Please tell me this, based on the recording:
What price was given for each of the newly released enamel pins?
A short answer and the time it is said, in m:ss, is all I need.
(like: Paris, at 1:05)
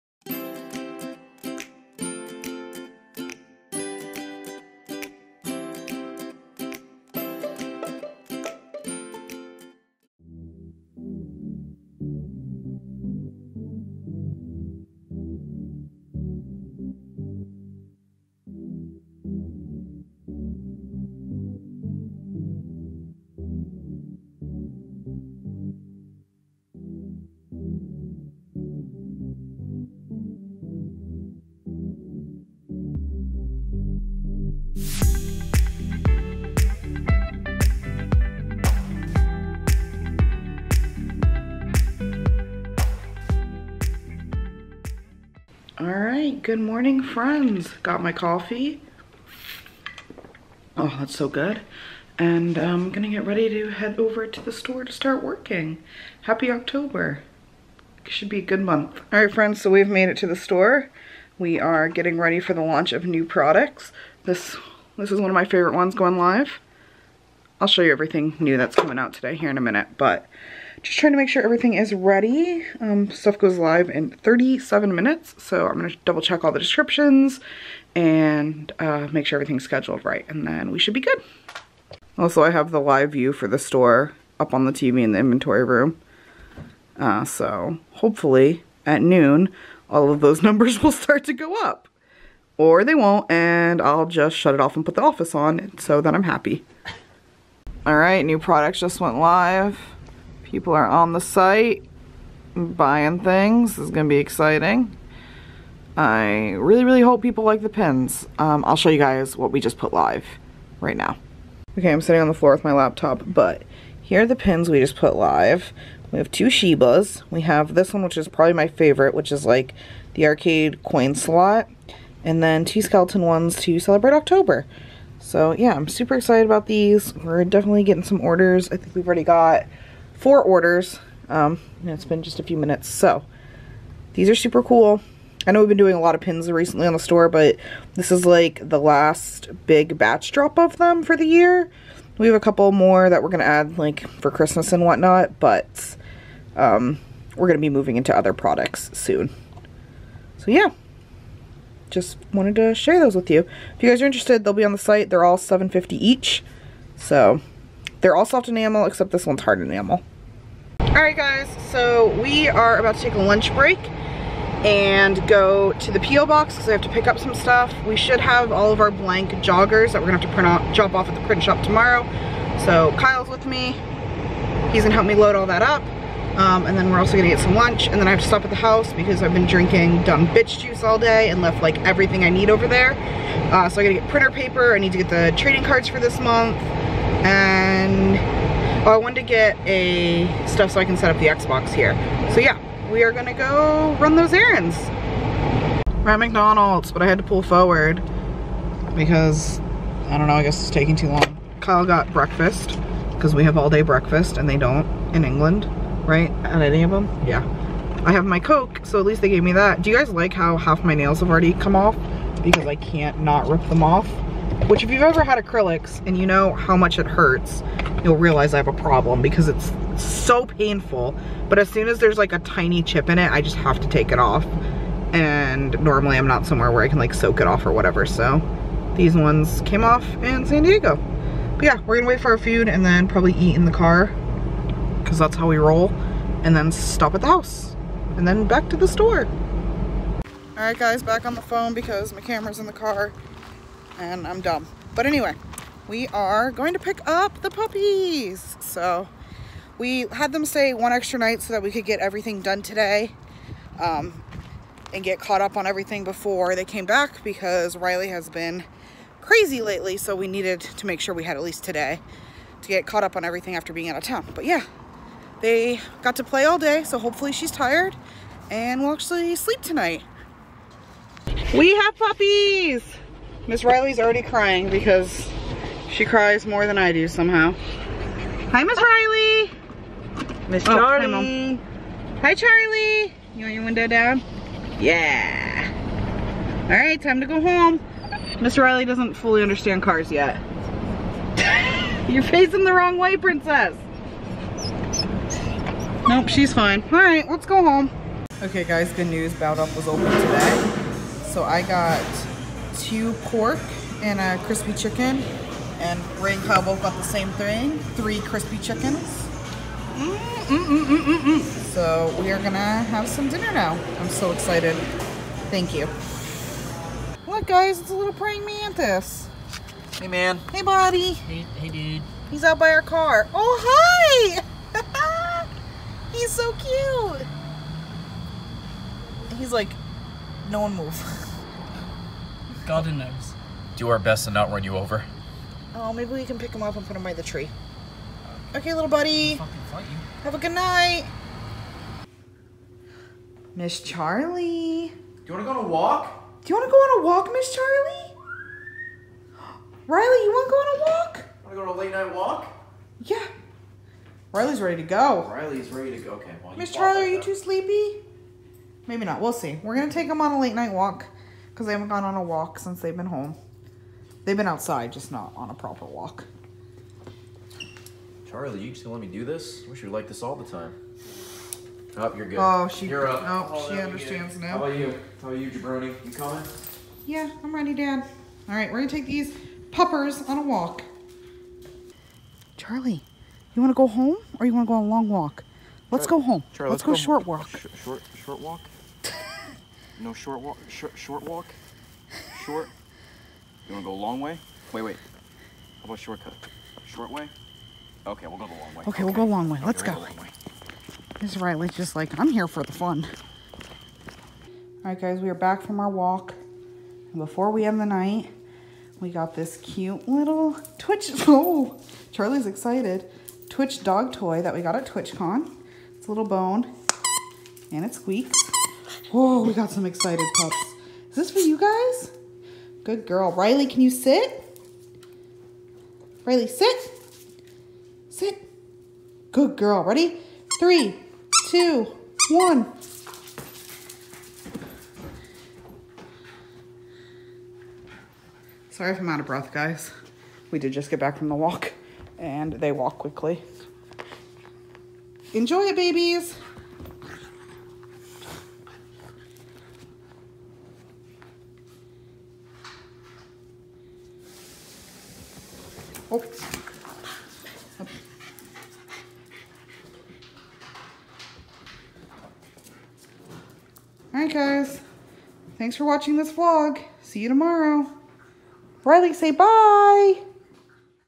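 7.50, at 2:35.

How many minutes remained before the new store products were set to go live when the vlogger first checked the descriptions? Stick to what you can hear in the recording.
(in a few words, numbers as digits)
37.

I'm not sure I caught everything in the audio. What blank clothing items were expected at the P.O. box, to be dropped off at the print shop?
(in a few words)
joggers.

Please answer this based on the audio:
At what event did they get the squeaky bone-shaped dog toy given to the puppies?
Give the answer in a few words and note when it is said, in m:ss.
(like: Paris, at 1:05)
TwitchCon, at 6:54.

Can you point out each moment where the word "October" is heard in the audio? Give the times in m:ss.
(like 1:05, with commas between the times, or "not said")
0:56, 2:04.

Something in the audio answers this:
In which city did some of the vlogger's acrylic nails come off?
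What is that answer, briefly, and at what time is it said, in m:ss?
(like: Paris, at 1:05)
San Diego, at 3:50.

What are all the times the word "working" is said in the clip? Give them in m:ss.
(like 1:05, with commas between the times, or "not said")
0:55.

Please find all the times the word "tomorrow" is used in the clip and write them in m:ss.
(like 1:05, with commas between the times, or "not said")
2:51, 7:47.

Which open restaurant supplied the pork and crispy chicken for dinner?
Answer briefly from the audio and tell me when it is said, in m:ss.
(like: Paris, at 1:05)
Bowed Up, at 4:59.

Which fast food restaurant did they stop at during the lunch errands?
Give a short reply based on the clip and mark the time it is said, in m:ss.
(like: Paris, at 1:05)
McDonald's, at 3:16.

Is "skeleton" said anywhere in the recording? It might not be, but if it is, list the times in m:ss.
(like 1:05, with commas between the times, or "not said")
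2:02.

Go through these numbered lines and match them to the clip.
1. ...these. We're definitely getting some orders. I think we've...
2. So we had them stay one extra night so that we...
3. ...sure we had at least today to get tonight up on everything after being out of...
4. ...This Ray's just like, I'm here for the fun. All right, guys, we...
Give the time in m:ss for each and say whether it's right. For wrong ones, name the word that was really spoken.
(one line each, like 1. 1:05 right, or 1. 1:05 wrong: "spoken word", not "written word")
1. 2:06 right
2. 4:08 right
3. 4:20 wrong: "caught", not "tonight"
4. 6:41 wrong: "Riley", not "Ray".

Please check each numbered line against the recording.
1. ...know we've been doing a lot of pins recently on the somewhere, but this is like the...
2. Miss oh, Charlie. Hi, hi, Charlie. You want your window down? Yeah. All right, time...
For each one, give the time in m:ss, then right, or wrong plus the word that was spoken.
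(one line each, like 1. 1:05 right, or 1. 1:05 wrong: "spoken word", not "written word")
1. 2:15 wrong: "store", not "somewhere"
2. 4:40 right.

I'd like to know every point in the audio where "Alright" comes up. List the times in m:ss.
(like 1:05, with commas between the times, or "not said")
2:40, 7:44.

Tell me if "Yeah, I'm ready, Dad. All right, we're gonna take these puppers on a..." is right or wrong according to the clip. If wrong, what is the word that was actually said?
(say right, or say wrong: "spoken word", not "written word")
right.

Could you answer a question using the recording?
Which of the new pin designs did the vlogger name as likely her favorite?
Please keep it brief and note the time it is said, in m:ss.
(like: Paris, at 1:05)
arcade coin slot, at 2:00.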